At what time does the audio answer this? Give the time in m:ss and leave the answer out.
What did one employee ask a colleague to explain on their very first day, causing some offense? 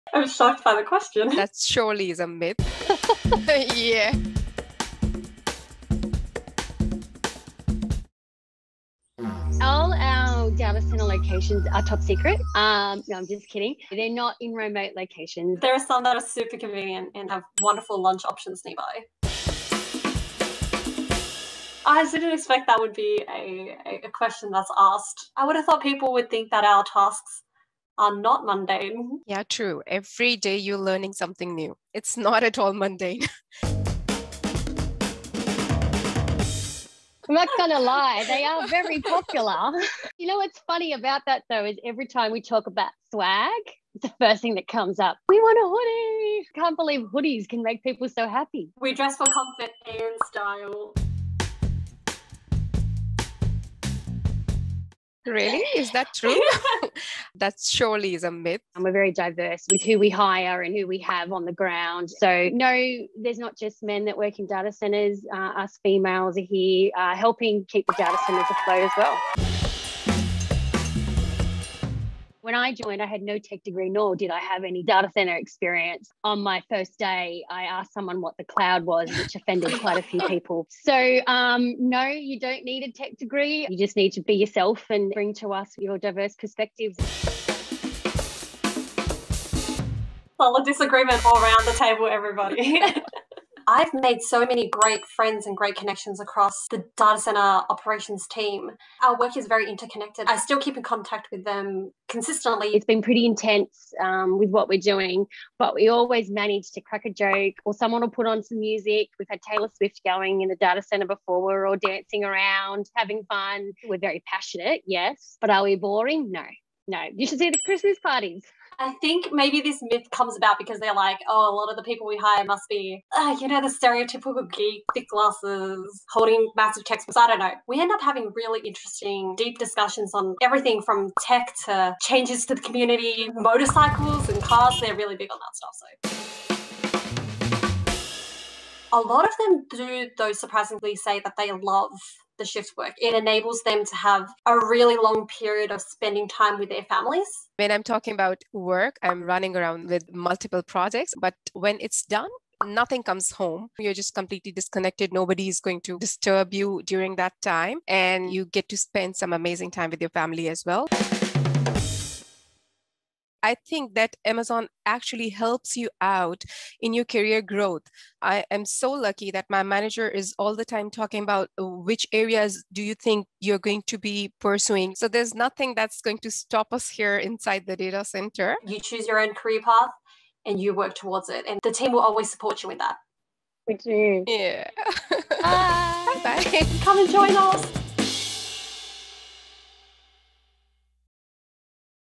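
1:18.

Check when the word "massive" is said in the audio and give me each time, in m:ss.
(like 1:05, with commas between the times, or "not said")
2:06.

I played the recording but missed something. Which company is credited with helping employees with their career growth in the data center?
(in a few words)
Amazon.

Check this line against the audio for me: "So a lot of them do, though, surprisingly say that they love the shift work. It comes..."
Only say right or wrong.
wrong.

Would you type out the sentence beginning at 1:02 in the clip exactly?
So, no, there's not just men that work in data centers.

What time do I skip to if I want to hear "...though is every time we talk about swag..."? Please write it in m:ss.
0:41.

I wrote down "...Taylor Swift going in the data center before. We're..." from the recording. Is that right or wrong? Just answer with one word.
right.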